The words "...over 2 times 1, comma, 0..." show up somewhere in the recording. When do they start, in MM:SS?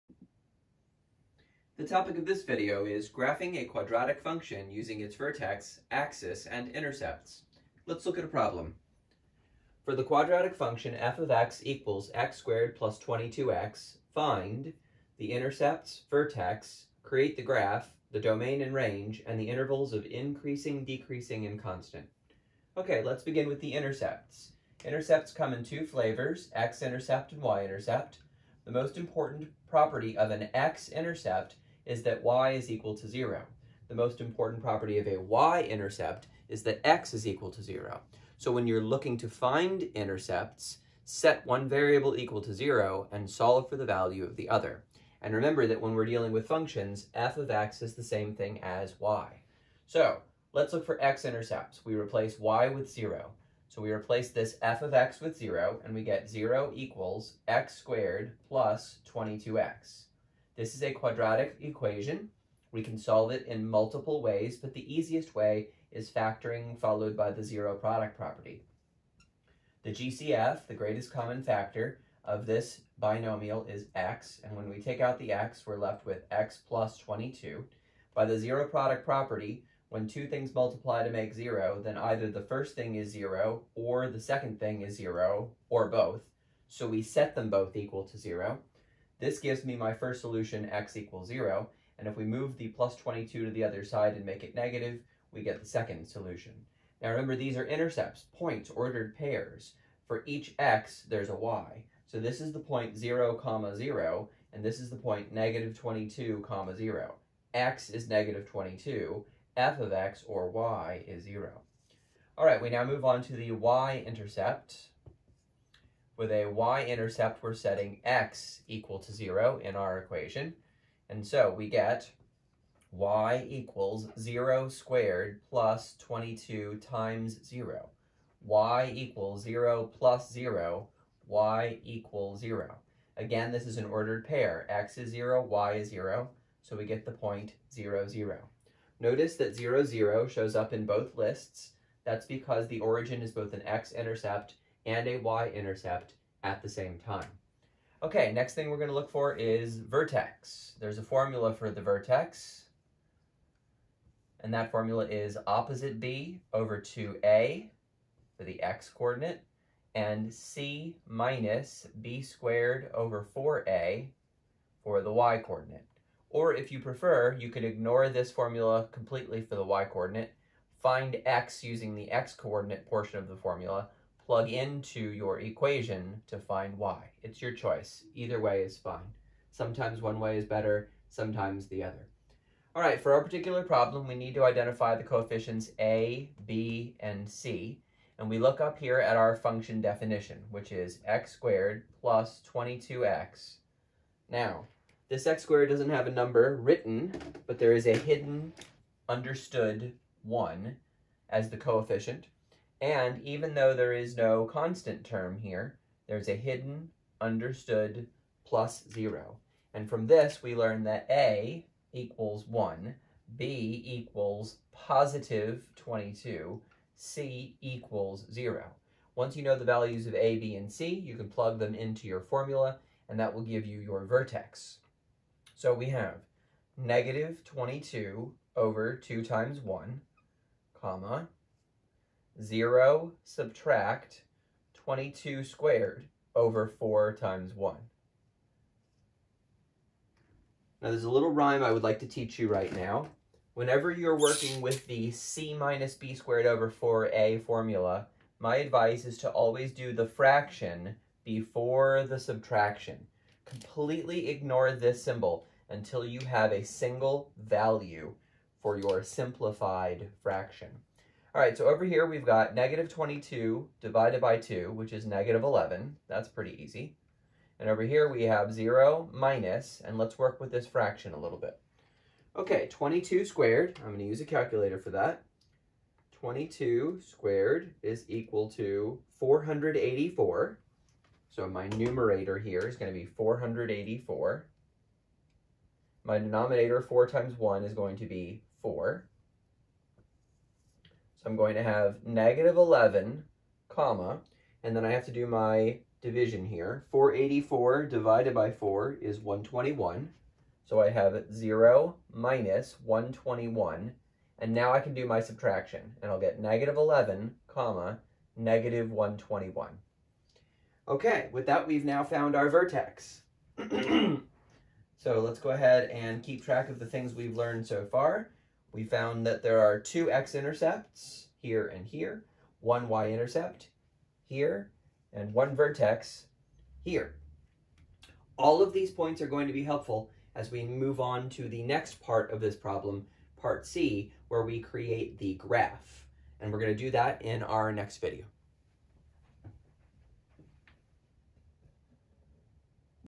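03:48.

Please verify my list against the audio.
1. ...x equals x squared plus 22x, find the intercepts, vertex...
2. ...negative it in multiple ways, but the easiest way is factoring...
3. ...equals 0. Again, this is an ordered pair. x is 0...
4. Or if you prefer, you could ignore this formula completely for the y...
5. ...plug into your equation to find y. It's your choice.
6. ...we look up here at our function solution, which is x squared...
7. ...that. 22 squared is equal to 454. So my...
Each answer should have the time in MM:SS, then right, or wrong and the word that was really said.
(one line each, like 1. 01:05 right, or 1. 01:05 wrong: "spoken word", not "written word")
1. 00:11 right
2. 01:02 wrong: "solve", not "negative"
3. 02:11 right
4. 02:46 right
5. 02:54 right
6. 03:08 wrong: "definition", not "solution"
7. 04:34 wrong: "484", not "454".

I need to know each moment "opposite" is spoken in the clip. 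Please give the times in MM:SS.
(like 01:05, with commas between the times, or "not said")
02:35.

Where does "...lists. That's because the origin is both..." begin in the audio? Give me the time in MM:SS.
02:21.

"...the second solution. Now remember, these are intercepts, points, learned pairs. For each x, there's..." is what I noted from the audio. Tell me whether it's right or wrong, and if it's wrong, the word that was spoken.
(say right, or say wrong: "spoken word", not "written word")
wrong: "ordered", not "learned".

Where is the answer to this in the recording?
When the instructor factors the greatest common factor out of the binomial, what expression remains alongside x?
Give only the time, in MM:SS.
01:16.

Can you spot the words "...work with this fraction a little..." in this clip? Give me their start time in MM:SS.
04:30.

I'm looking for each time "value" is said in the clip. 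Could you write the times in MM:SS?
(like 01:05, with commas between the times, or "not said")
00:43, 03:39, 04:17.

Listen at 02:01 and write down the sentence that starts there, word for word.
And so we get y equals 0 squared plus 22 times 0.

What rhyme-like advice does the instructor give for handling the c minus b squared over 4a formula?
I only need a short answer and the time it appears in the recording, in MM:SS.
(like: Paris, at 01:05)
fraction before the subtraction, at 04:10.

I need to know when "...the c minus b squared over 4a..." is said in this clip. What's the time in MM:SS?
04:04.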